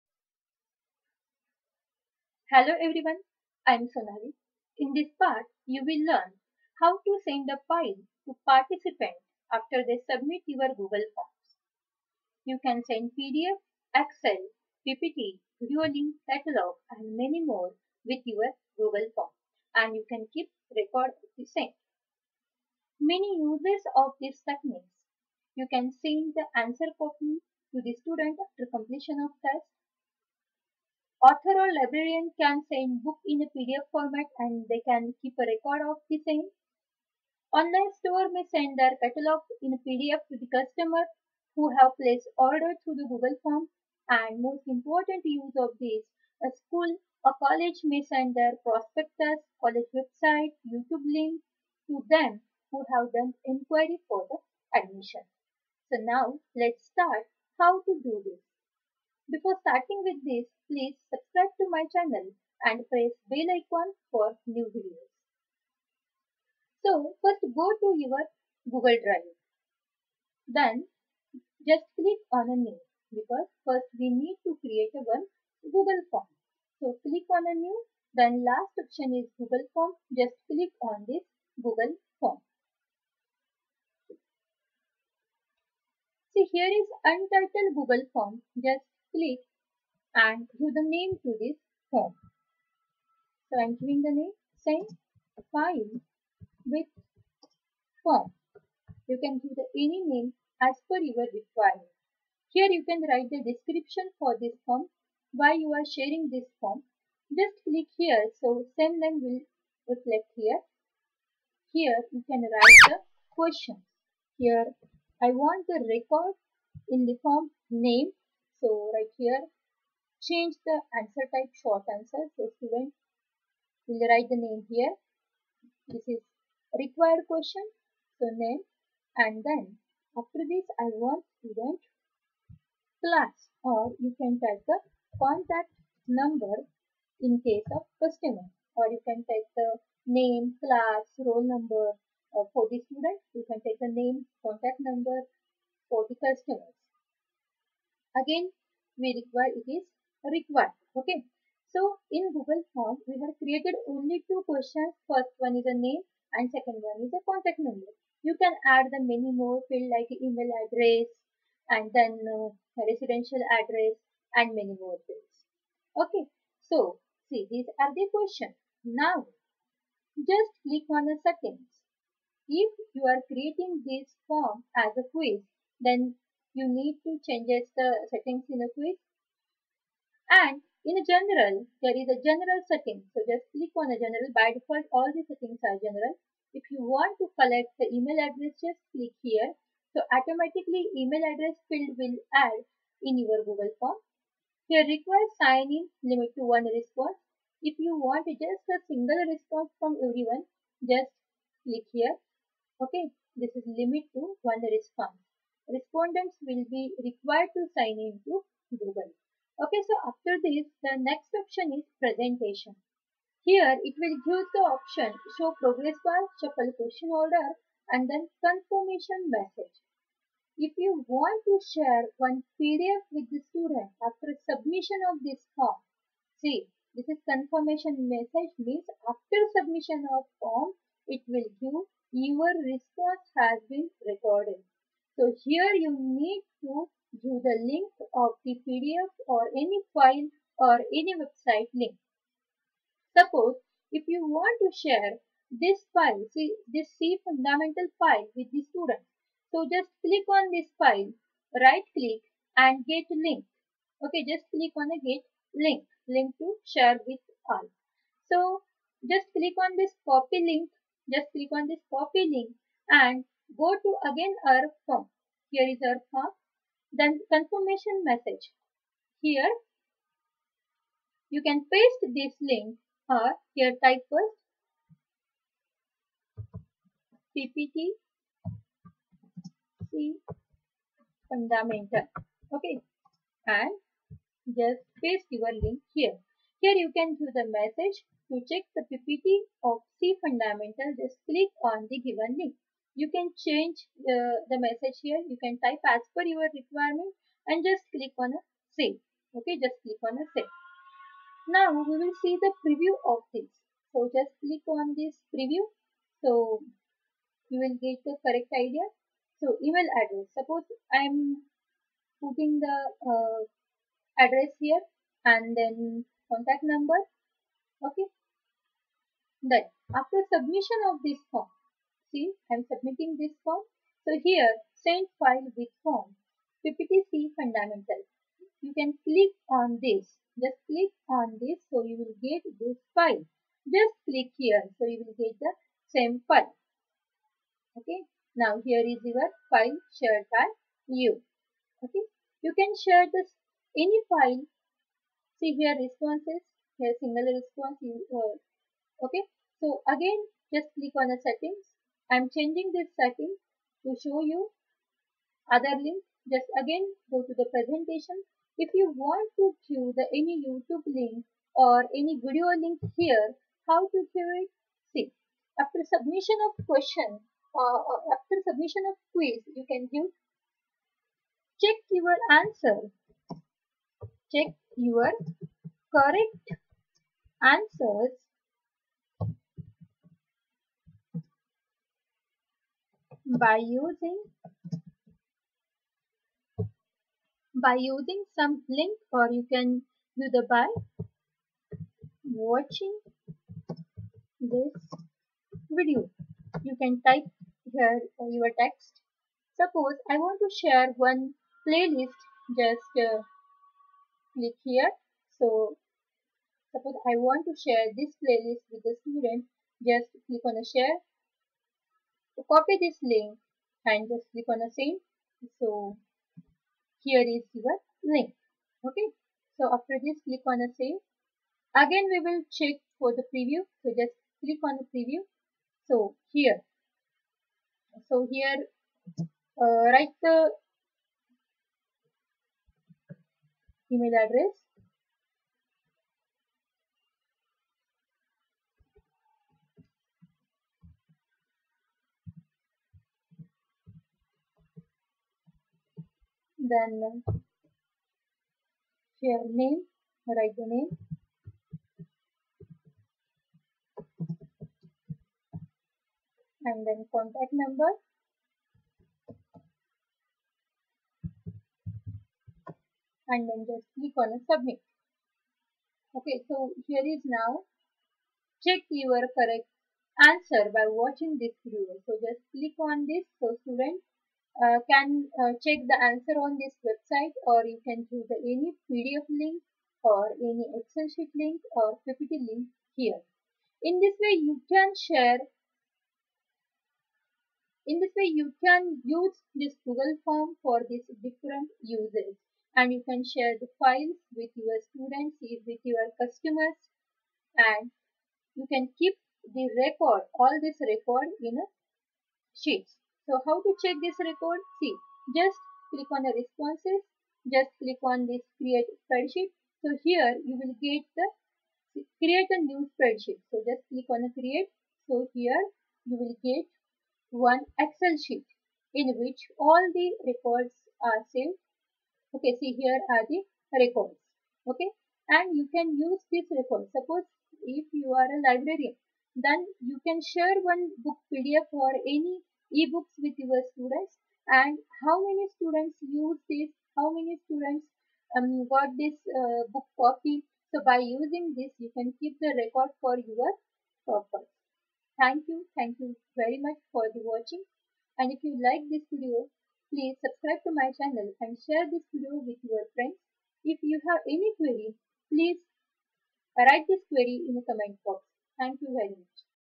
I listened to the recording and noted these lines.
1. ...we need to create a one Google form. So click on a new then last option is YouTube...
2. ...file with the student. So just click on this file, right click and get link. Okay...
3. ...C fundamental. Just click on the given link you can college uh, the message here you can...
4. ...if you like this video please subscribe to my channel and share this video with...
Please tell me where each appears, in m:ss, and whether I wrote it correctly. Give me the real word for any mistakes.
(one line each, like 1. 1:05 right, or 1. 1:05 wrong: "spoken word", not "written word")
1. 1:13 wrong: "Google", not "YouTube"
2. 4:07 right
3. 4:49 wrong: "change", not "college"
4. 9:08 right.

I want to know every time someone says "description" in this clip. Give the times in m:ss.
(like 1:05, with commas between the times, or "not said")
1:43.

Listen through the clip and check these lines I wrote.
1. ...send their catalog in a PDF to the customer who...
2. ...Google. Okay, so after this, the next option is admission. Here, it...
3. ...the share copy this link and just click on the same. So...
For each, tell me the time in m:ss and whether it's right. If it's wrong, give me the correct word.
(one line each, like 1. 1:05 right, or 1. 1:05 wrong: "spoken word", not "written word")
1. 0:38 right
2. 3:28 wrong: "presentation", not "admission"
3. 6:50 right.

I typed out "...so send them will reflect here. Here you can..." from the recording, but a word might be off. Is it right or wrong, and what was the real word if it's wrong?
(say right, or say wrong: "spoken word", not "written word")
right.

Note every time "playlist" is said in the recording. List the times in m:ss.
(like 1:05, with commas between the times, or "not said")
6:41, 6:48.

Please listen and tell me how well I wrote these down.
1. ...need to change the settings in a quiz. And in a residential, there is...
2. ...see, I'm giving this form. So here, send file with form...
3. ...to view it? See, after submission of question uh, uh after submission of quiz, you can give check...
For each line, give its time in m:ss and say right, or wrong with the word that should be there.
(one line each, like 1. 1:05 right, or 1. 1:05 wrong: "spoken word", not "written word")
1. 2:56 wrong: "general", not "residential"
2. 5:22 wrong: "submitting", not "giving"
3. 6:03 right.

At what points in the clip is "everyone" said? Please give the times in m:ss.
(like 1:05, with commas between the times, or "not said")
0:02, 3:20.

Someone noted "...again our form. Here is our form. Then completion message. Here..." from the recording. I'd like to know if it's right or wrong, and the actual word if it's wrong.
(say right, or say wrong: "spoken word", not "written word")
wrong: "confirmation", not "completion".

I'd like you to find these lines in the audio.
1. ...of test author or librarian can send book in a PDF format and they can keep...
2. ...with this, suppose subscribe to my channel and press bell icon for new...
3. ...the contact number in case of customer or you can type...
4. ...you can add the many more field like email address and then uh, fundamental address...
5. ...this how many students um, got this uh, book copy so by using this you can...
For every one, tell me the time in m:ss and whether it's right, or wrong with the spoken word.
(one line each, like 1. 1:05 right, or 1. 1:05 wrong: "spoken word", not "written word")
1. 0:29 right
2. 1:00 wrong: "please", not "suppose"
3. 2:14 right
4. 2:38 wrong: "residential", not "fundamental"
5. 8:56 right.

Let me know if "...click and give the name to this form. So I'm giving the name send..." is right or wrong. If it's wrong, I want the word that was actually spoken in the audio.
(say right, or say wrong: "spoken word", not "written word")
right.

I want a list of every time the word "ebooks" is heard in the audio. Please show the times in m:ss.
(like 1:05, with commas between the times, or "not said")
8:52.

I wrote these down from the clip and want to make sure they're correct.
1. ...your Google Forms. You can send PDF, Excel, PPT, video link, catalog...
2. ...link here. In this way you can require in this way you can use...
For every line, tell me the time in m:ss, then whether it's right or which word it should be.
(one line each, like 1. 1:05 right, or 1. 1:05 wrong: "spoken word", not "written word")
1. 0:10 right
2. 8:02 wrong: "share", not "require".